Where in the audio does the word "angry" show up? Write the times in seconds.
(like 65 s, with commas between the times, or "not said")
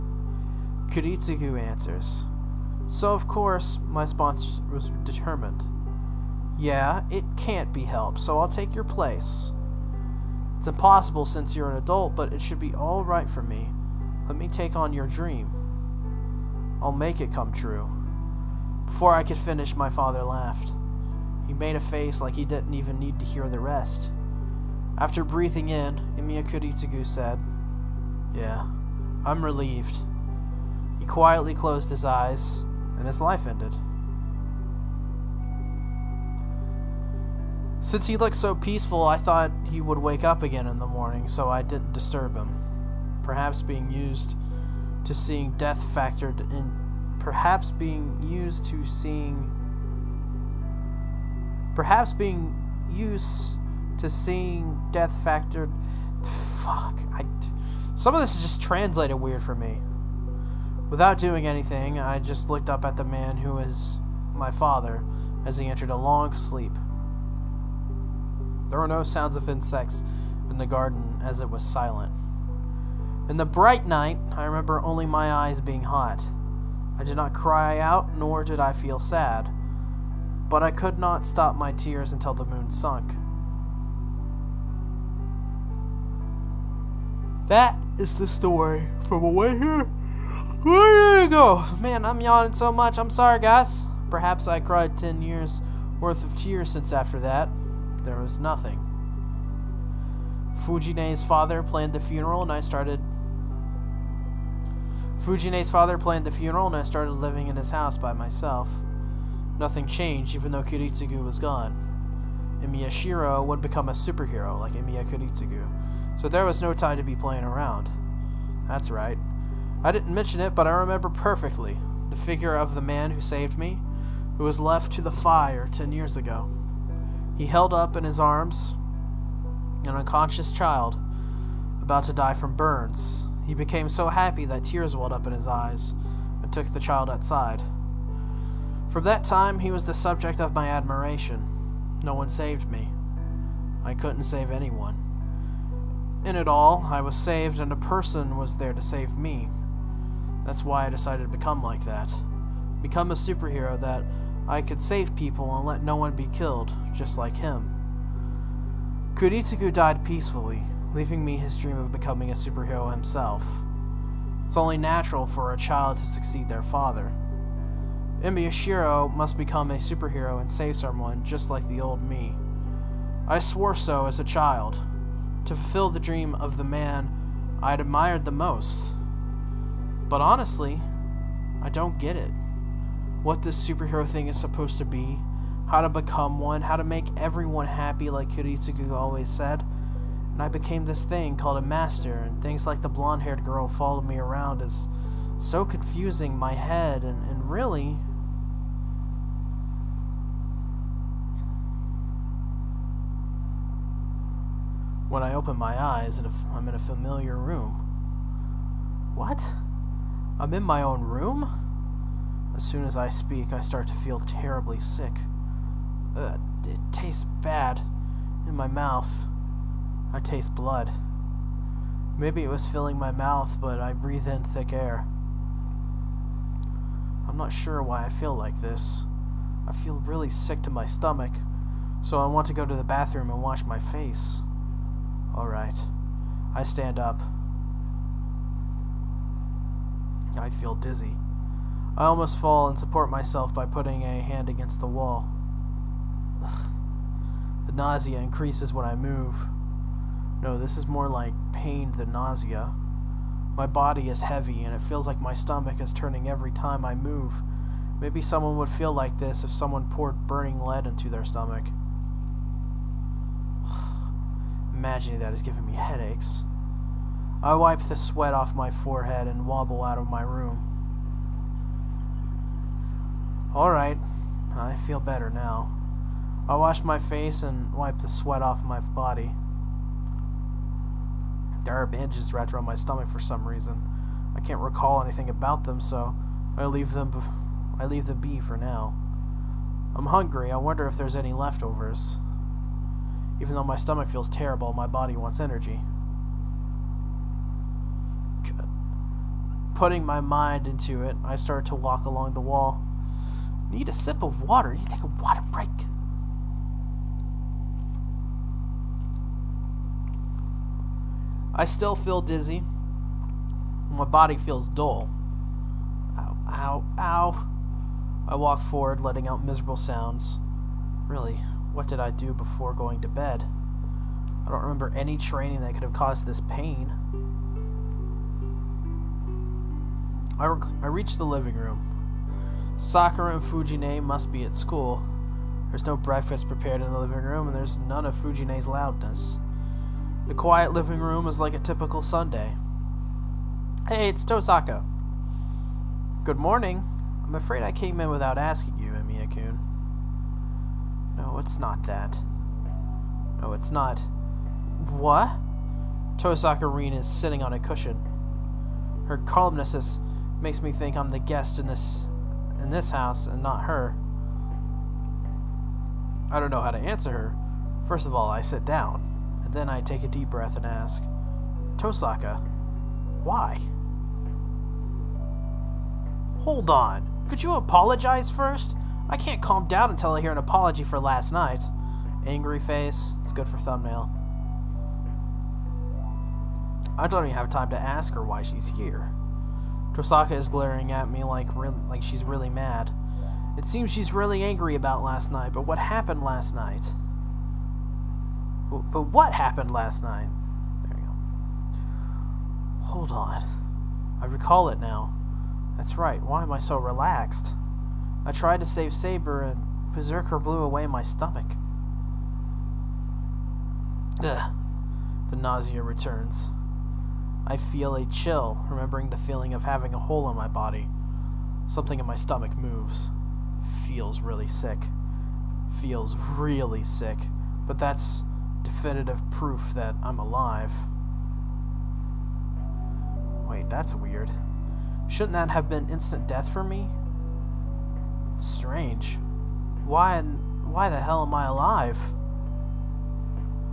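382 s, 394 s.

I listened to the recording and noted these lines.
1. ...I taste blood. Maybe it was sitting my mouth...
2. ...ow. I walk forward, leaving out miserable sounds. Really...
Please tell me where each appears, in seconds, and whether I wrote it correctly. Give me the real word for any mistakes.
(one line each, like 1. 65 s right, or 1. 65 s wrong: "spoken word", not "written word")
1. 220 s wrong: "filling", not "sitting"
2. 316 s wrong: "letting", not "leaving".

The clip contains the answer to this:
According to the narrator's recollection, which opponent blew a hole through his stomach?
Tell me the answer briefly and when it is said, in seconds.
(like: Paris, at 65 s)
Berserker, at 409 s.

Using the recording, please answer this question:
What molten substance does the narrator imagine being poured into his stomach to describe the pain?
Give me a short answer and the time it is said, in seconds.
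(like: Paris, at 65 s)
burning lead, at 260 s.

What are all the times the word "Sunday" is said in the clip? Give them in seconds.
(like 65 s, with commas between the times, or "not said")
342 s.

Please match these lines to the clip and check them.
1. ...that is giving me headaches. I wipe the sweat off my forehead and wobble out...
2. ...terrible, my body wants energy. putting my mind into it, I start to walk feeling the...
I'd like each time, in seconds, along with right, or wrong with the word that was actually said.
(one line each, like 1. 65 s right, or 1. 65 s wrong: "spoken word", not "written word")
1. 265 s right
2. 294 s wrong: "along", not "feeling".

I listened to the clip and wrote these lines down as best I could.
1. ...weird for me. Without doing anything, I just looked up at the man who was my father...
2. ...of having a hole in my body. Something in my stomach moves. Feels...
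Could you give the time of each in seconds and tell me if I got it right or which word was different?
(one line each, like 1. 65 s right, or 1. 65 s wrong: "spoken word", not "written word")
1. 59 s right
2. 419 s right.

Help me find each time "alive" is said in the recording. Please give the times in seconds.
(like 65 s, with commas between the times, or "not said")
430 s, 441 s.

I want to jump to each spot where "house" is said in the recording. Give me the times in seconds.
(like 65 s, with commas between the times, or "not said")
107 s, 362 s.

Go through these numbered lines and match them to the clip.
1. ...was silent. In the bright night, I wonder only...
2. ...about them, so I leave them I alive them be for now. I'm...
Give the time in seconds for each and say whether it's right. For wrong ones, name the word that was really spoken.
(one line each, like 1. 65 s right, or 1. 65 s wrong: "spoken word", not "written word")
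1. 71 s wrong: "remember", not "wonder"
2. 285 s wrong: "leave", not "alive".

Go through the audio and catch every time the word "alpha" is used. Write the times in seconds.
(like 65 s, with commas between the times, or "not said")
not said.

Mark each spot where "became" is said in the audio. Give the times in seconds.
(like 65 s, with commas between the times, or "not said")
133 s, 190 s.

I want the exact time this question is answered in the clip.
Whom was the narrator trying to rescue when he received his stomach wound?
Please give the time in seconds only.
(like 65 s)
408 s.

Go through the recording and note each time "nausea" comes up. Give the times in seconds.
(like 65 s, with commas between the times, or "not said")
247 s, 252 s, 415 s.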